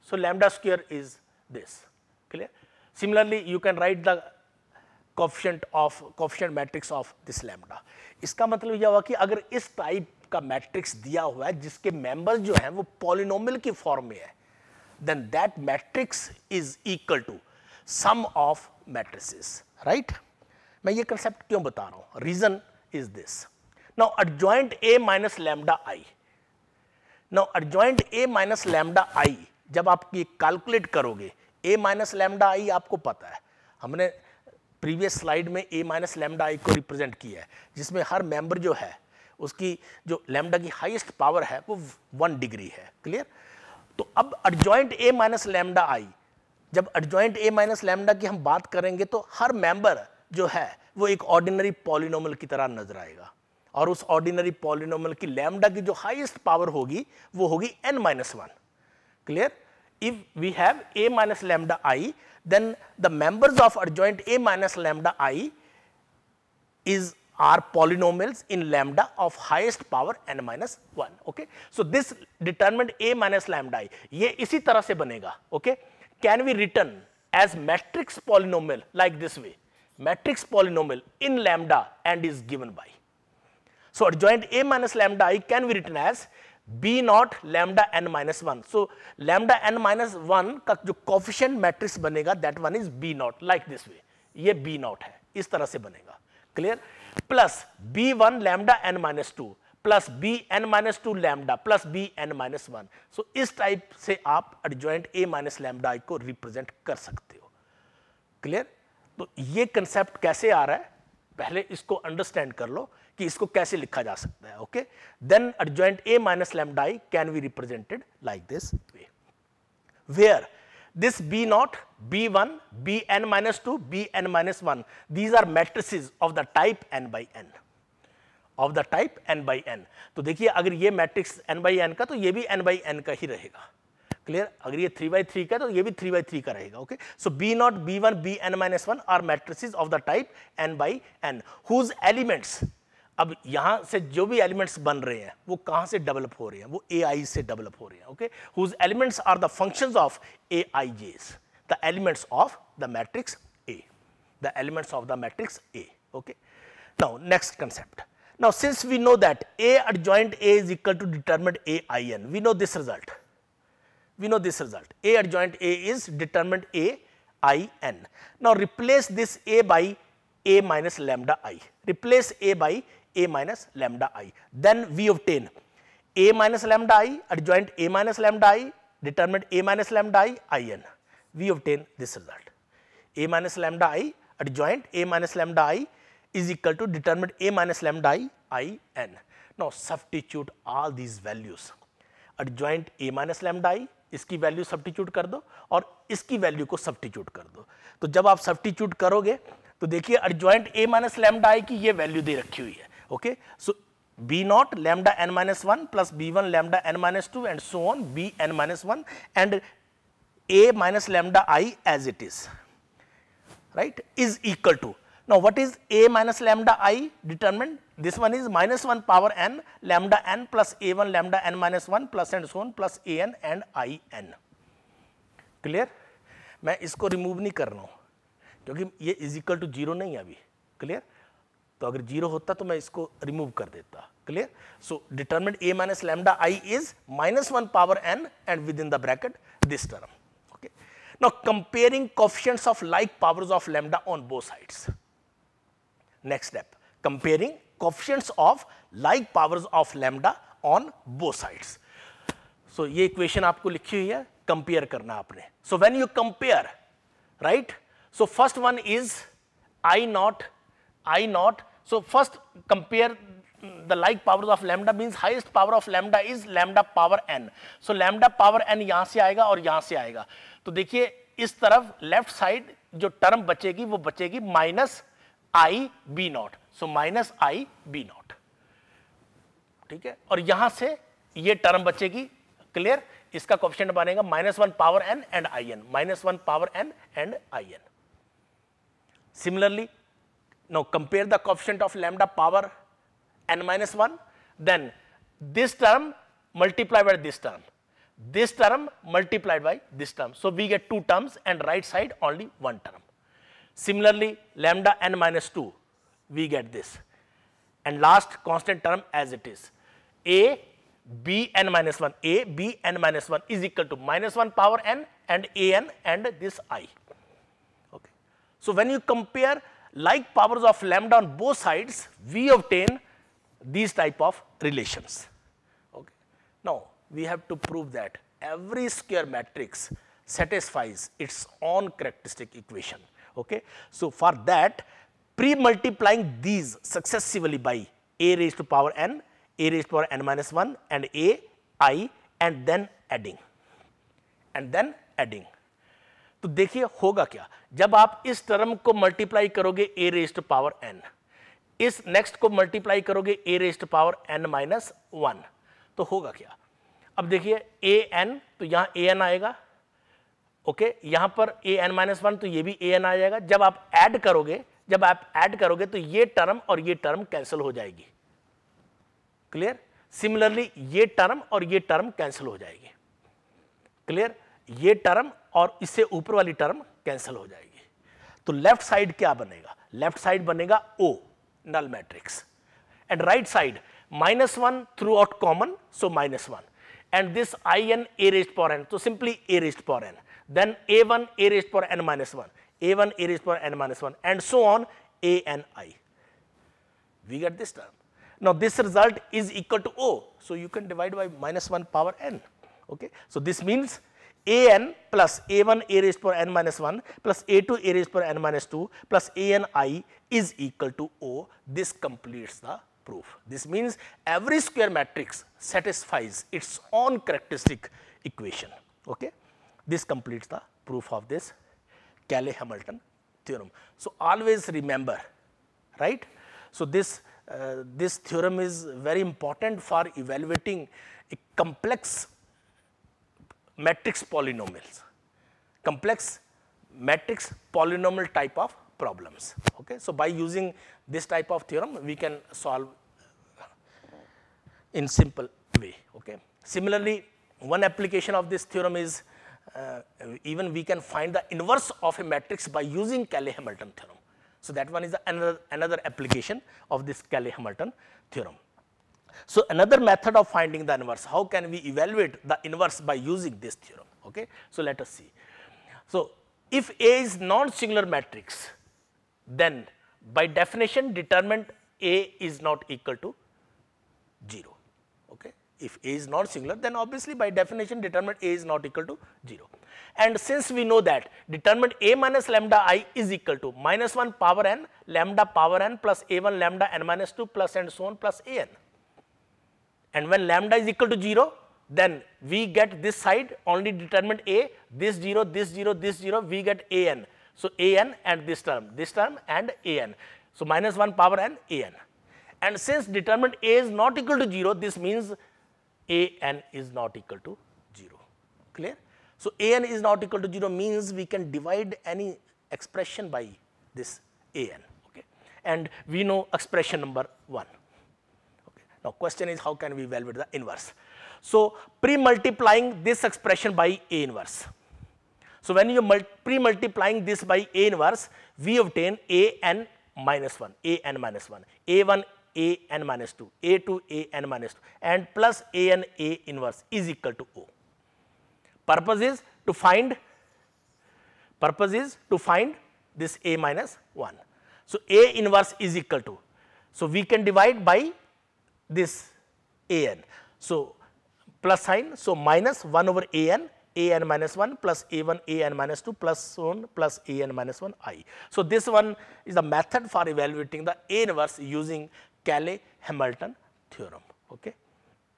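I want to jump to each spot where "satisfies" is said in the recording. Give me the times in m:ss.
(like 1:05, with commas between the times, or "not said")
5:30, 6:55.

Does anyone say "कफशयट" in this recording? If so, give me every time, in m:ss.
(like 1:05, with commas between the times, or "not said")
1:31, 4:02, 4:07.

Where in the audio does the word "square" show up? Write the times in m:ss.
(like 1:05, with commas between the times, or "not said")
0:00, 5:28, 6:54.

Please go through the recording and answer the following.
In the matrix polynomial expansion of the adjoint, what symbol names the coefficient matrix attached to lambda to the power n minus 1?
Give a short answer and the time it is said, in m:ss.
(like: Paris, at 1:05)
B naught, at 1:26.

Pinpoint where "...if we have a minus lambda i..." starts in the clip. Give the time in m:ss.
1:00.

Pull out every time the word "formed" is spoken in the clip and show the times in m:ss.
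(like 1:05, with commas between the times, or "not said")
not said.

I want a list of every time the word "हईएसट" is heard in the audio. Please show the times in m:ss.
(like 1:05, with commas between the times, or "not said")
0:40, 0:55.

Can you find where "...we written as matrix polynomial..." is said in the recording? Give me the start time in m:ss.
1:16.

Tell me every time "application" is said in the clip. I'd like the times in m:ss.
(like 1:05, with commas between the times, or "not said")
7:27, 7:36.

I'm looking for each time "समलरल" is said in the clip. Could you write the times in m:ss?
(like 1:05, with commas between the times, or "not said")
4:49, 6:10.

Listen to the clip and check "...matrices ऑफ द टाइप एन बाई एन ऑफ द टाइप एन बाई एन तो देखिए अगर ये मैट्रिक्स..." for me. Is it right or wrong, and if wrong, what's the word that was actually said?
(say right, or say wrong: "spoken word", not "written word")
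right.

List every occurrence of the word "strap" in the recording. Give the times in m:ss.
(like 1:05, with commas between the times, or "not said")
not said.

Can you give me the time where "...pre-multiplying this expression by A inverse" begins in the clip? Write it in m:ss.
8:42.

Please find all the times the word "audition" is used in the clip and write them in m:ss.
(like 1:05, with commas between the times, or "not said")
not said.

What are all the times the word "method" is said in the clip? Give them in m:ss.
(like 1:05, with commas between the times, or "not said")
7:39, 9:19.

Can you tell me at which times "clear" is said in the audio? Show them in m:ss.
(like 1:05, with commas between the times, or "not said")
0:02, 3:45, 8:28.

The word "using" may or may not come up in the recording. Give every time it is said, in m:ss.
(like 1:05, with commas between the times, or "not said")
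7:20, 7:32, 7:43, 9:21.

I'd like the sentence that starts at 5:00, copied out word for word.
So we get two terms and right side only one term.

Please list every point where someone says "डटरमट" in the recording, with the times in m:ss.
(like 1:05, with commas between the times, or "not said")
2:41, 2:46, 3:55.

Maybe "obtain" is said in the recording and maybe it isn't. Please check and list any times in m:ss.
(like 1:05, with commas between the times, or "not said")
2:55, 3:01, 5:22, 8:48.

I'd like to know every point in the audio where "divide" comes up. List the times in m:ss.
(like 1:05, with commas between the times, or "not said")
8:31, 9:07.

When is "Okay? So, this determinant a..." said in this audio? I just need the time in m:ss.
1:11.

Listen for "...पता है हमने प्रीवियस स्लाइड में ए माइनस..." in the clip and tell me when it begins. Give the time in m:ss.
0:33.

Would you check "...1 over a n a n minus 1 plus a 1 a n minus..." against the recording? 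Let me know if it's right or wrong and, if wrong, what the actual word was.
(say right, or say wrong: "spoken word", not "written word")
right.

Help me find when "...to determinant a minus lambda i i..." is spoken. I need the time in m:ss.
3:06.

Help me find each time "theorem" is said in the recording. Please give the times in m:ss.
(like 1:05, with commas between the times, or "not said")
7:03, 7:08, 7:21, 7:28, 7:33, 7:38, 7:43, 9:23.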